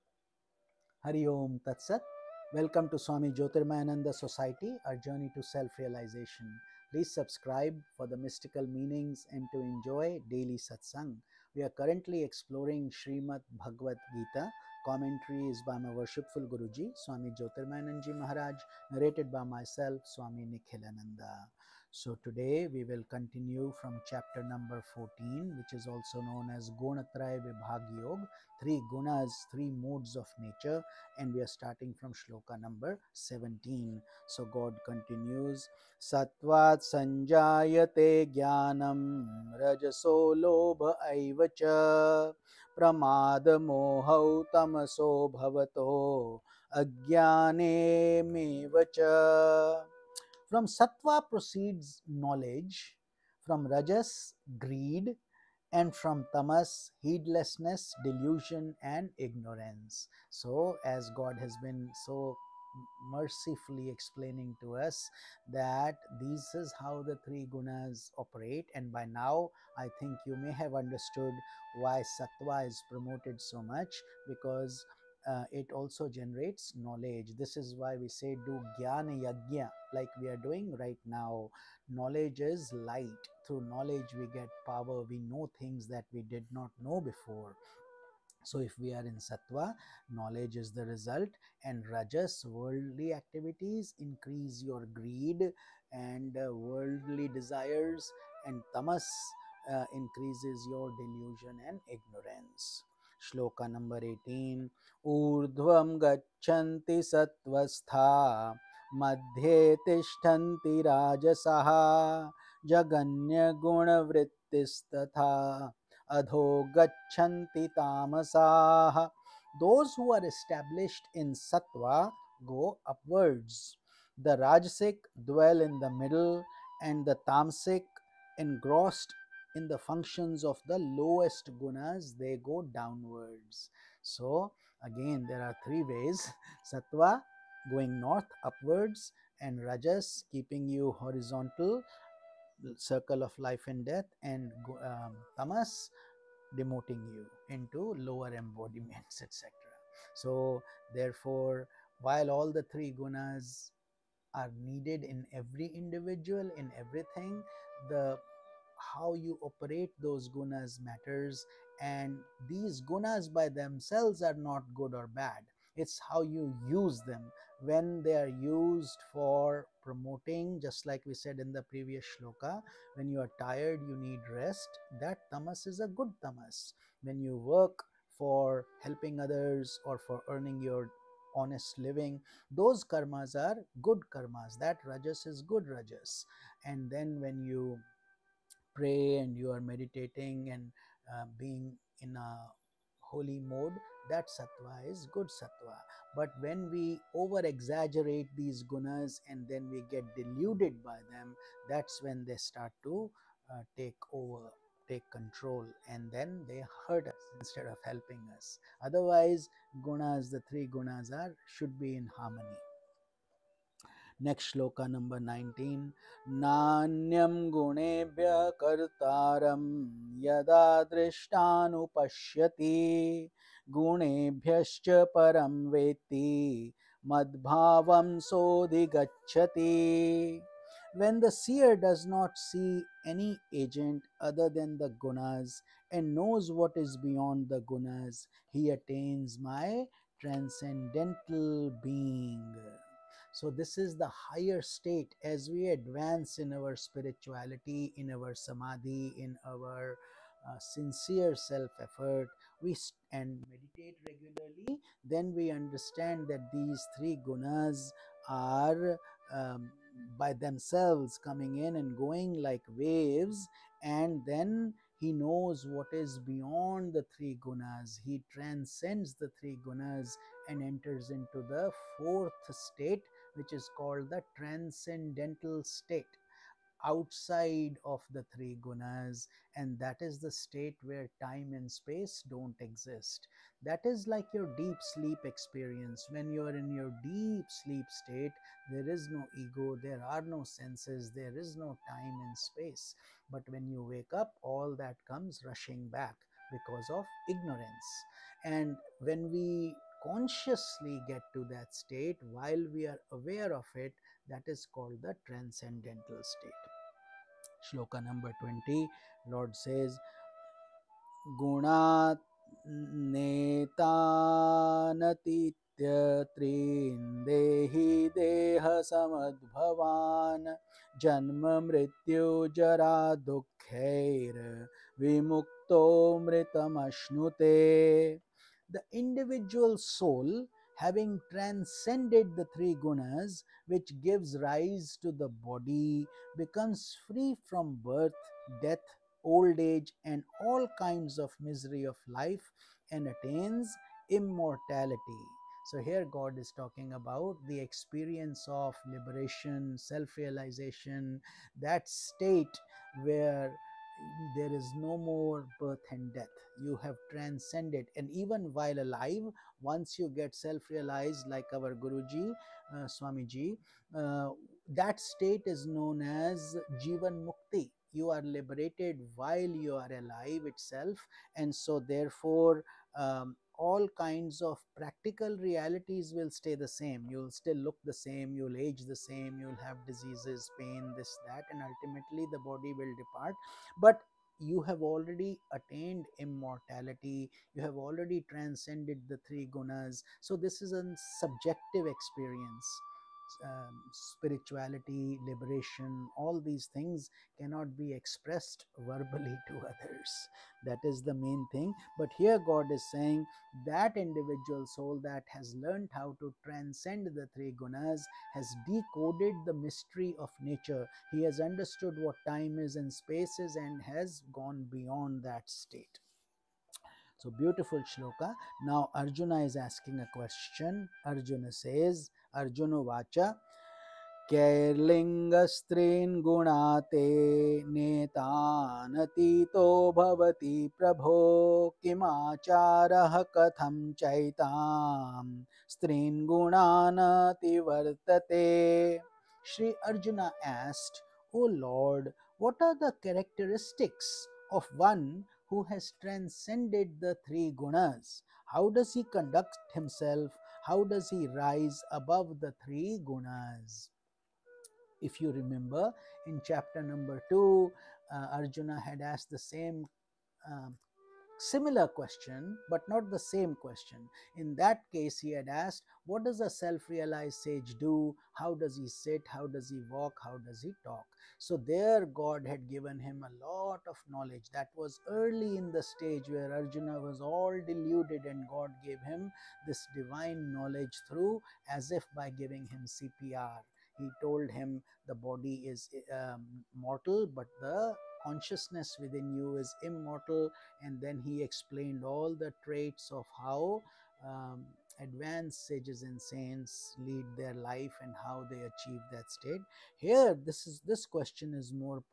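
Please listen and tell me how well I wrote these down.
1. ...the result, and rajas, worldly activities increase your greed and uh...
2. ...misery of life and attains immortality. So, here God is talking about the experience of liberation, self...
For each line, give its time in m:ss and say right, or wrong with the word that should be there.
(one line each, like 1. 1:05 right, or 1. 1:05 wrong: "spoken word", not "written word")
1. 1:30 right
2. 5:41 right.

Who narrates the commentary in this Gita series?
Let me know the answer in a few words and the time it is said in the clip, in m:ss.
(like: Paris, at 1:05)
Swami Nikhilananda, at 0:20.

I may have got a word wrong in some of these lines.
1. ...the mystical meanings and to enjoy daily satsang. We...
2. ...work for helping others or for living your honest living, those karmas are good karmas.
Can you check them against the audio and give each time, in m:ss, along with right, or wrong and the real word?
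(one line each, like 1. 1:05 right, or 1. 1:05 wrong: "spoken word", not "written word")
1. 0:08 right
2. 2:57 wrong: "earning", not "living".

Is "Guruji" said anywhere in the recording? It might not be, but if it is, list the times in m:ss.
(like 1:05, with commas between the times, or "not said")
0:16, 6:01.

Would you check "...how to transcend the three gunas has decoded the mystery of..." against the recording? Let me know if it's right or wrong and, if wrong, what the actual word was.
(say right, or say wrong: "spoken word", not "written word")
right.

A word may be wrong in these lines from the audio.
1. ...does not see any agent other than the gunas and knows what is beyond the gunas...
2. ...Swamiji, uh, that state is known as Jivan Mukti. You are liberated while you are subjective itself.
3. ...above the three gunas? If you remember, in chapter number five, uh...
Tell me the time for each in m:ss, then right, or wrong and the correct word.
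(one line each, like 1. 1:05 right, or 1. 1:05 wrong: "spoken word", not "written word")
1. 3:51 right
2. 6:02 wrong: "alive", not "subjective"
3. 7:31 wrong: "two", not "five".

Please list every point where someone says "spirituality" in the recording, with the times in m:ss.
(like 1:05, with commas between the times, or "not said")
4:06, 6:33.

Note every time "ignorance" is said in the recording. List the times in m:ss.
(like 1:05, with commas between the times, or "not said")
0:59, 1:41, 4:57.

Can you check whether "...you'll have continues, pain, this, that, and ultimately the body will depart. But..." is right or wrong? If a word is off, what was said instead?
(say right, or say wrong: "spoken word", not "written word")
wrong: "diseases", not "continues".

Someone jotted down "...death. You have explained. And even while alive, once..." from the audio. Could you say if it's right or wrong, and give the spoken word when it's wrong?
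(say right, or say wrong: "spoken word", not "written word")
wrong: "transcended", not "explained".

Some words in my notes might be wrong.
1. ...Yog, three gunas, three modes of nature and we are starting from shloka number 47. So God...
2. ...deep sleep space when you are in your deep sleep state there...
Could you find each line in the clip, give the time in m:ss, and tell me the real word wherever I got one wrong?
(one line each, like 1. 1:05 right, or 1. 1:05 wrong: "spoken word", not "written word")
1. 0:28 wrong: "17", not "47"
2. 4:44 wrong: "experience", not "space".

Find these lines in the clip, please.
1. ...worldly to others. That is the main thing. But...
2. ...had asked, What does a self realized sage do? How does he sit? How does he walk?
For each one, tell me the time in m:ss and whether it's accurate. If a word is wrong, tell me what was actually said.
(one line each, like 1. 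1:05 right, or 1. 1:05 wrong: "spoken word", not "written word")
1. 6:38 wrong: "verbally", not "worldly"
2. 7:45 right.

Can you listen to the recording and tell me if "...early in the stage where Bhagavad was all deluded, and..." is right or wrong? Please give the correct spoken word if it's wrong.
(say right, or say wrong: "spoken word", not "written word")
wrong: "Arjuna", not "Bhagavad".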